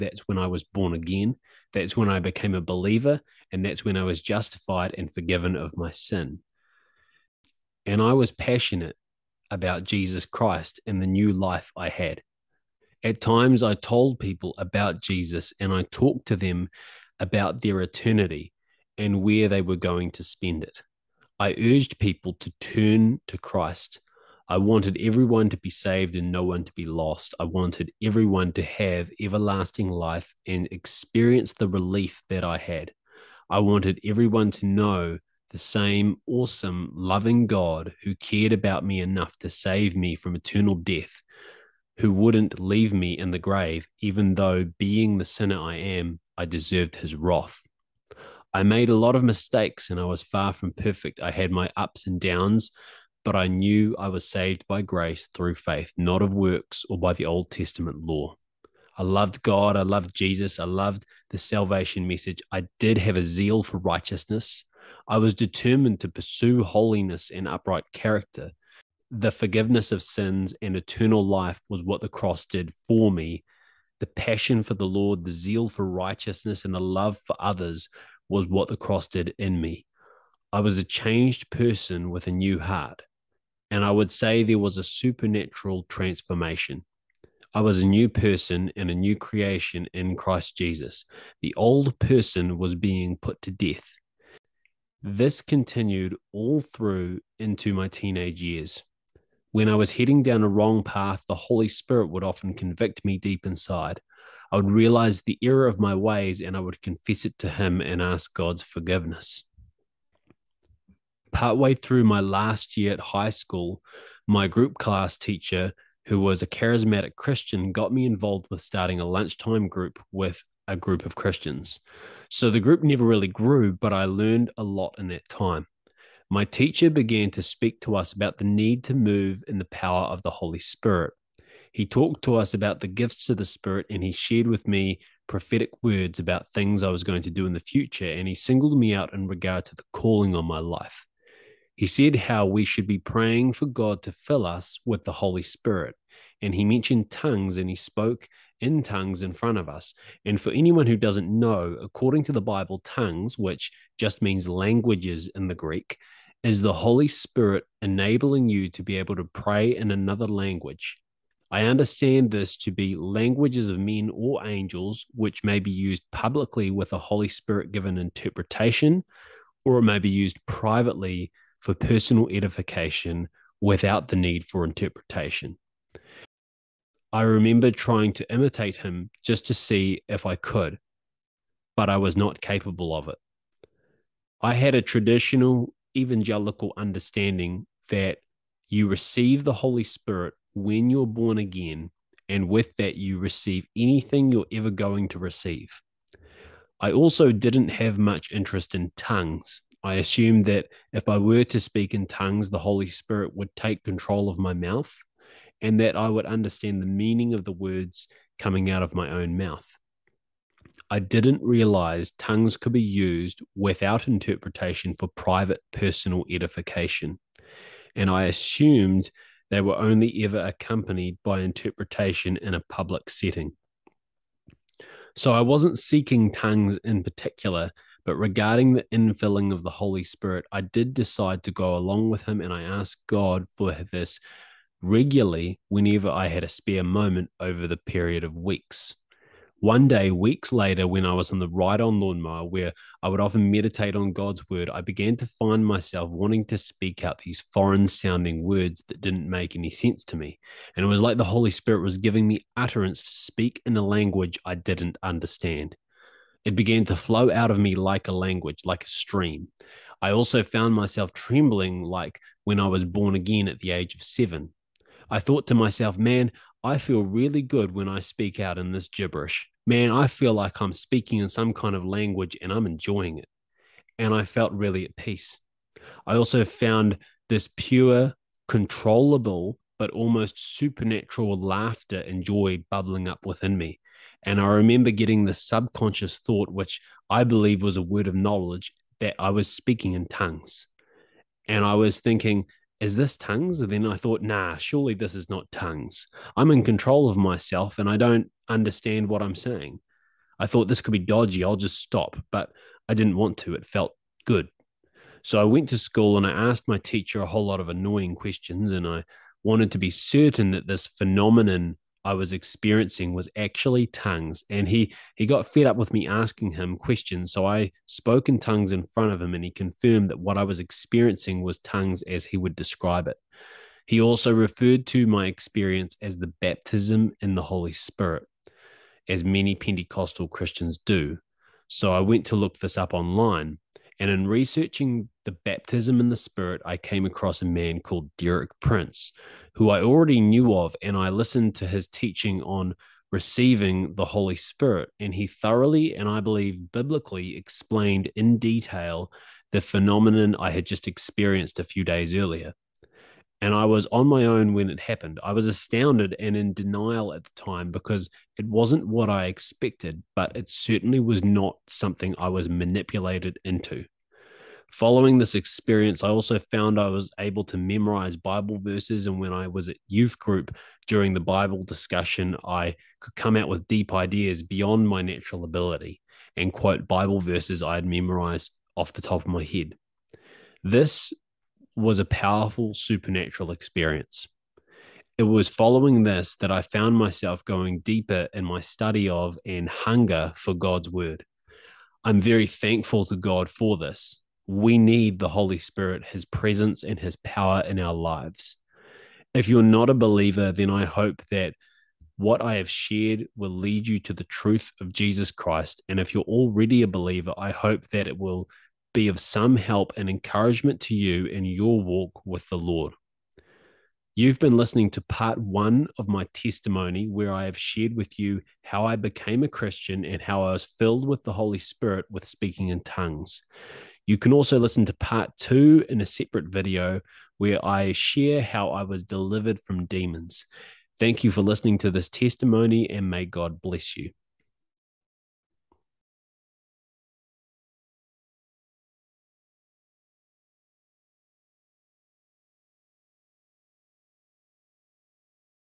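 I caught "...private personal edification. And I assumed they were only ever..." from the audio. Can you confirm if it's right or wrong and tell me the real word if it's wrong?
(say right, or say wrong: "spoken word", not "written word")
right.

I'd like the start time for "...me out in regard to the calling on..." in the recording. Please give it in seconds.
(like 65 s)
138 s.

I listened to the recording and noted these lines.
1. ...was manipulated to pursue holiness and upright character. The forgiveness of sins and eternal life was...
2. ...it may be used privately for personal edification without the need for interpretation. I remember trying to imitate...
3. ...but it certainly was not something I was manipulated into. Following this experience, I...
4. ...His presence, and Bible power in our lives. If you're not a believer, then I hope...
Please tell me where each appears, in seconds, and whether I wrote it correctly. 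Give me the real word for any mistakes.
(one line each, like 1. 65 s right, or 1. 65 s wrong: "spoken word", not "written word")
1. 65 s wrong: "determined", not "manipulated"
2. 169 s right
3. 360 s right
4. 396 s wrong: "His", not "Bible".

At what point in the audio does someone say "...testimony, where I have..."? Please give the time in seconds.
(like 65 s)
416 s.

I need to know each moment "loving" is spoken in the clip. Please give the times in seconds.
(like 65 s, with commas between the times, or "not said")
36 s.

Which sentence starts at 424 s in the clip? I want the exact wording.
You can also listen to part two in a separate video where I share how I was delivered from demons.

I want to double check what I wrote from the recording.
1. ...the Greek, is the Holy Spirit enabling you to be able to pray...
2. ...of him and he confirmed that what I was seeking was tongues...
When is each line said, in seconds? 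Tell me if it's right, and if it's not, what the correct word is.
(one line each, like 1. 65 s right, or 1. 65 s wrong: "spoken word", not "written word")
1. 155 s right
2. 319 s wrong: "experiencing", not "seeking".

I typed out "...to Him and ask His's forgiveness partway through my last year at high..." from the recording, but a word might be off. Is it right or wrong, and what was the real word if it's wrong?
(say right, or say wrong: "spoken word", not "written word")
wrong: "God", not "His".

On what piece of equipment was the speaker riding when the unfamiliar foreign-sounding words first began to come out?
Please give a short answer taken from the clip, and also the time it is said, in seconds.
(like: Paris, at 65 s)
ride on lawnmower, at 241 s.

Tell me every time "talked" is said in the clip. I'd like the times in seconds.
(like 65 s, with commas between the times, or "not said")
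15 s, 131 s.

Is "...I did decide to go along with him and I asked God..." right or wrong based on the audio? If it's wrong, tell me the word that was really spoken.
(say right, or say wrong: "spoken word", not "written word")
right.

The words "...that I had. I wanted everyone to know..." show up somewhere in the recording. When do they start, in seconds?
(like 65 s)
32 s.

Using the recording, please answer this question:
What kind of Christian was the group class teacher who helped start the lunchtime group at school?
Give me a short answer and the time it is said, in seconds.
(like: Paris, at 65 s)
charismatic, at 116 s.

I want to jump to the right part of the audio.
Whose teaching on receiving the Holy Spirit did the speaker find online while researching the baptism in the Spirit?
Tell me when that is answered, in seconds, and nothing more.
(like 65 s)
338 s.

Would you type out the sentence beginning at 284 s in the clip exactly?
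And I remember getting the subconscious thought, which I believe was a word of knowledge, that I was speaking in tongues.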